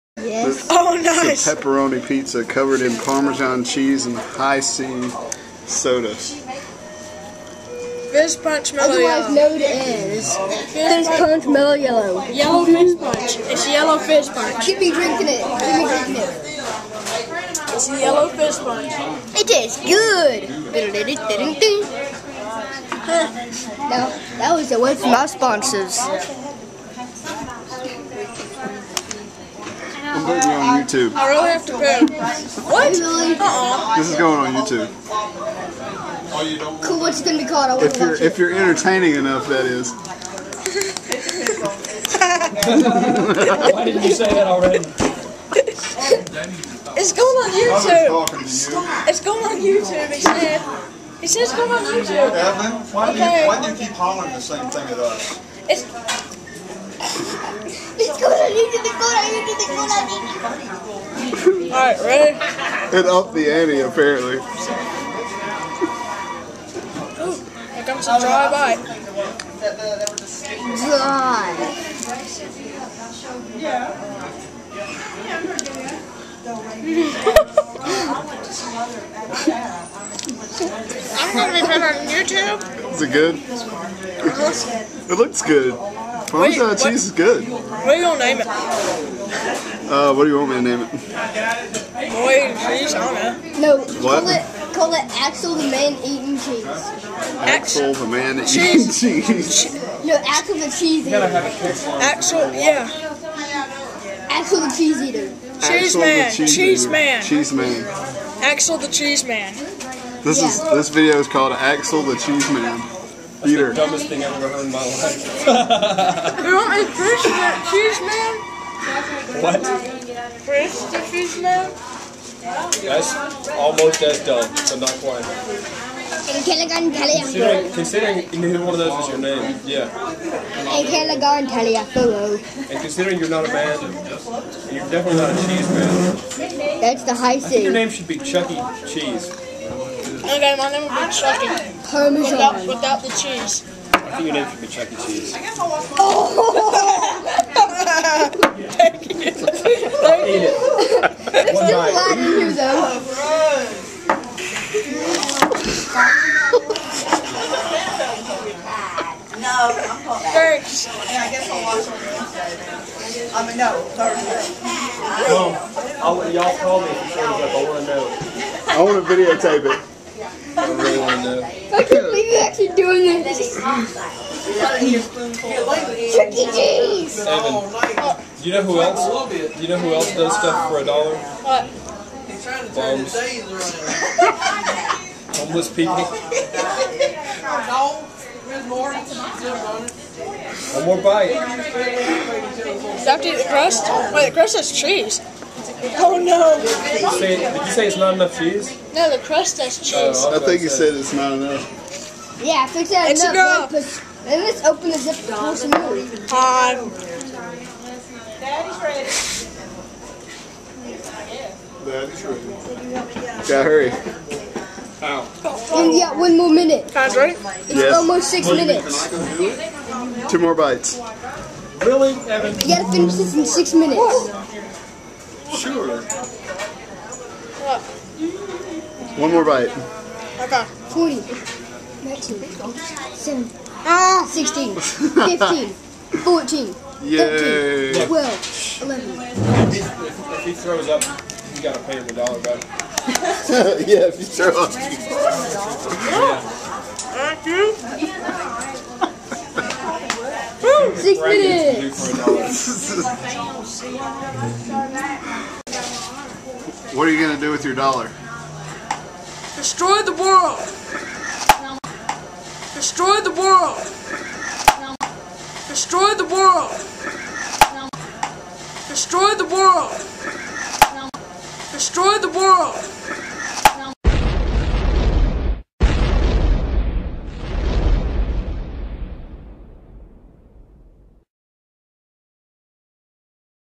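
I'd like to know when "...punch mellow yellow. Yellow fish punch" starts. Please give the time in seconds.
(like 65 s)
11 s.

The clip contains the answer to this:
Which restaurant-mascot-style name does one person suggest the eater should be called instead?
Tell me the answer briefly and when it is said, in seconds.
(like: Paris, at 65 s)
Chuck E. Cheese, at 144 s.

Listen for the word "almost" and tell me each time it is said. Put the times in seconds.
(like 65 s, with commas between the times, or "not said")
123 s, 217 s.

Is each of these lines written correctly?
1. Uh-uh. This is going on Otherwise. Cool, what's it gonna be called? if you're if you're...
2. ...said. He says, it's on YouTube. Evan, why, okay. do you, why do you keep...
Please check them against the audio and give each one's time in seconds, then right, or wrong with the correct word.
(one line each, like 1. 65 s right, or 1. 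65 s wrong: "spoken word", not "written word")
1. 32 s wrong: "YouTube", not "Otherwise"
2. 50 s right.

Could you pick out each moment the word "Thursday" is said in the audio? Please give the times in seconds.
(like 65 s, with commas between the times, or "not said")
163 s.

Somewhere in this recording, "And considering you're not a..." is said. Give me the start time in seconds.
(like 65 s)
130 s.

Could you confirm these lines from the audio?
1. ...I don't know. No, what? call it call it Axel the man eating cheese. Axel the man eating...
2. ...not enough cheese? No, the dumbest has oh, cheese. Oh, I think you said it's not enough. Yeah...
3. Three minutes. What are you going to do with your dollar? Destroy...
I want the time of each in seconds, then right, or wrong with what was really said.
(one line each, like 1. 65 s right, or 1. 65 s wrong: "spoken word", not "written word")
1. 92 s right
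2. 197 s wrong: "crust", not "dumbest"
3. 250 s wrong: "Six", not "Three".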